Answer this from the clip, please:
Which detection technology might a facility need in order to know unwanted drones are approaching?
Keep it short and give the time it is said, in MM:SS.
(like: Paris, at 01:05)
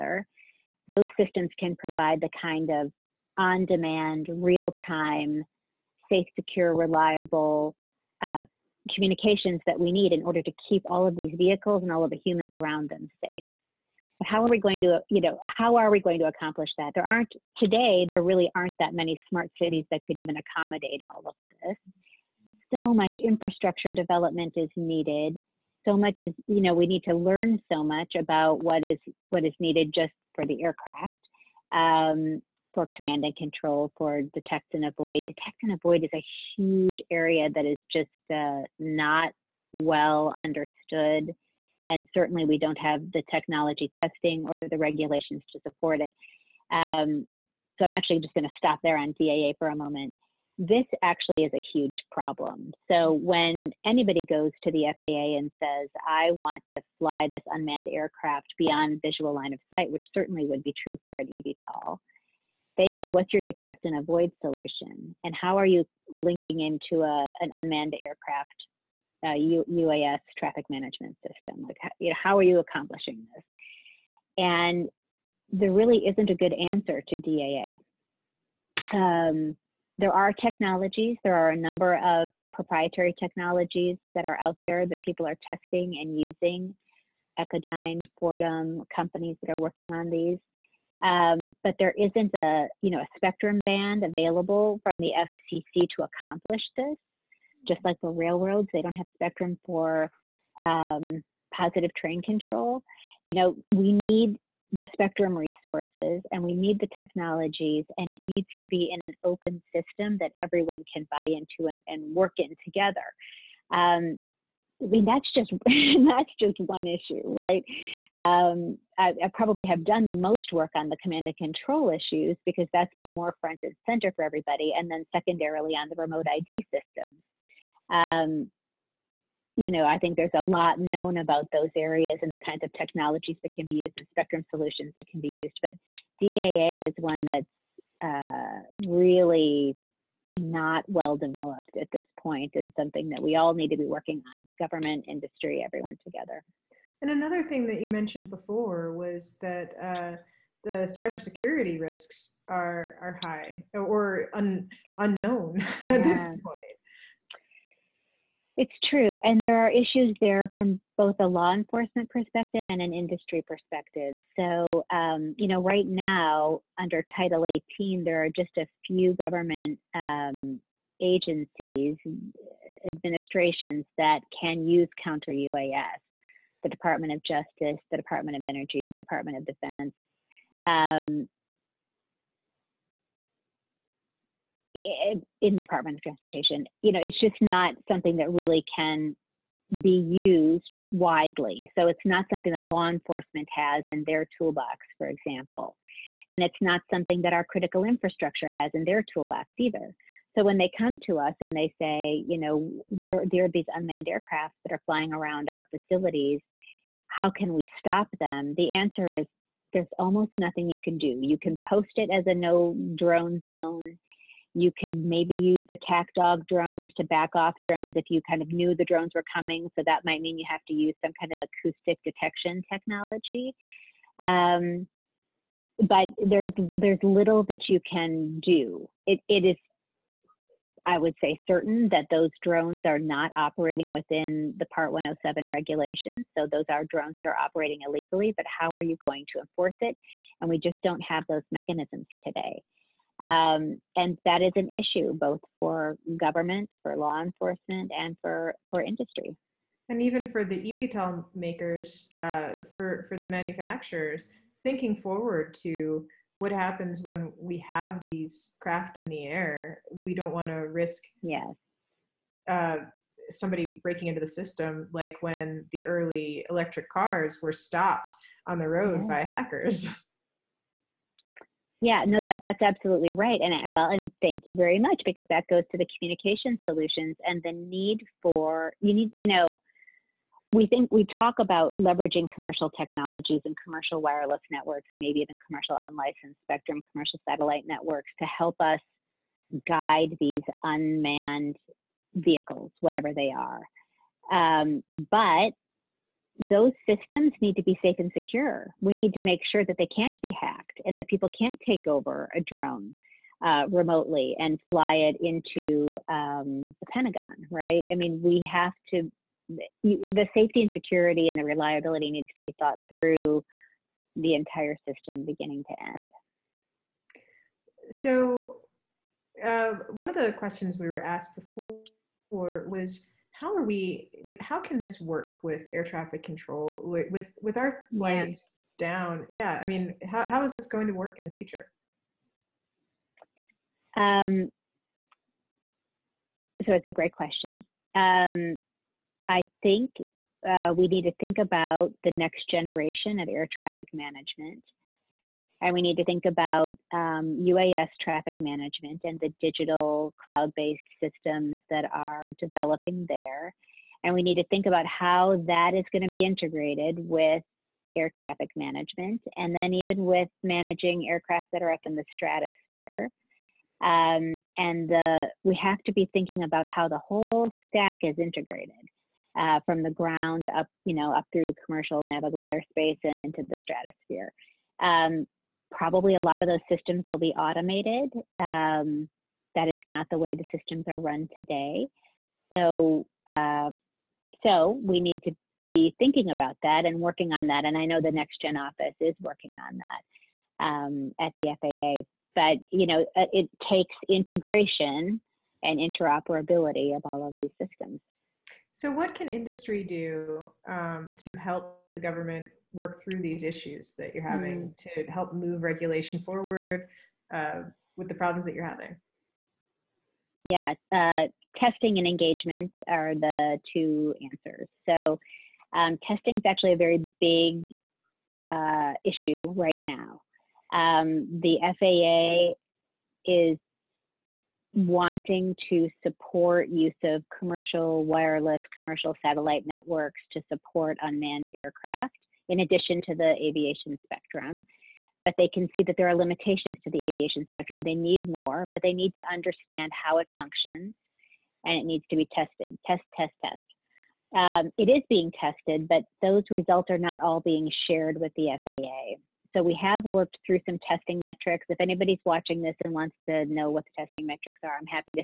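Acoustic detection, at 03:41.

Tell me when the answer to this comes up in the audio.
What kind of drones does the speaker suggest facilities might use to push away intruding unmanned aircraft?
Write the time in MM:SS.
03:35.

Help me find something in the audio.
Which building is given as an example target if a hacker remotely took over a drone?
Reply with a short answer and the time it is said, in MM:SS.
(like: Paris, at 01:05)
The Pentagon, at 05:06.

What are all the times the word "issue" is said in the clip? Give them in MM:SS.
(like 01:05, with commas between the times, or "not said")
01:56, 02:01, 02:39, 04:04, 06:43, 06:59.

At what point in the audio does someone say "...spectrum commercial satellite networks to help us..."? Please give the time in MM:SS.
04:46.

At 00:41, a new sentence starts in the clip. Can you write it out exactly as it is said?
And certainly, we don't have the technology testing or the regulations to support it.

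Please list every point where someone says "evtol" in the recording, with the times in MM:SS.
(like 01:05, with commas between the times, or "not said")
01:01, 04:10.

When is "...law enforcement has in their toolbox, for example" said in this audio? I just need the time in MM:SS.
03:12.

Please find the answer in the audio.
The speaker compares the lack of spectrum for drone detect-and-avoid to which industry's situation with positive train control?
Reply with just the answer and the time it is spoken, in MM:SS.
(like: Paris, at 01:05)
Railroads, at 01:38.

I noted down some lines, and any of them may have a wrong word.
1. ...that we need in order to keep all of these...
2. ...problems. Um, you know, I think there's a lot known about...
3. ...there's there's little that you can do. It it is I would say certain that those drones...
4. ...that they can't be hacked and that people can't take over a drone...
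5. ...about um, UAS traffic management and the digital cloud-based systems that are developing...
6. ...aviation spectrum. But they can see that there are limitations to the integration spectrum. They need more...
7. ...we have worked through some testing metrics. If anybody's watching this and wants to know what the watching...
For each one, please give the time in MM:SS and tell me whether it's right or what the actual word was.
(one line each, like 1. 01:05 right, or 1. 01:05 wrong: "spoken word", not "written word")
1. 00:09 right
2. 02:06 wrong: "systems", not "problems"
3. 03:46 right
4. 04:59 right
5. 05:46 right
6. 07:13 wrong: "aviation", not "integration"
7. 07:29 wrong: "testing", not "watching".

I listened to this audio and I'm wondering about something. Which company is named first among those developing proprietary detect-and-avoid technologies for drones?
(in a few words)
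Echodyne.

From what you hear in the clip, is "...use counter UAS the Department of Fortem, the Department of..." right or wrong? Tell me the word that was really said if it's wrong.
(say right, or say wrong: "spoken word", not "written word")
wrong: "Justice", not "Fortem".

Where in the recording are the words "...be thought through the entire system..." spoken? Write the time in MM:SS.
05:12.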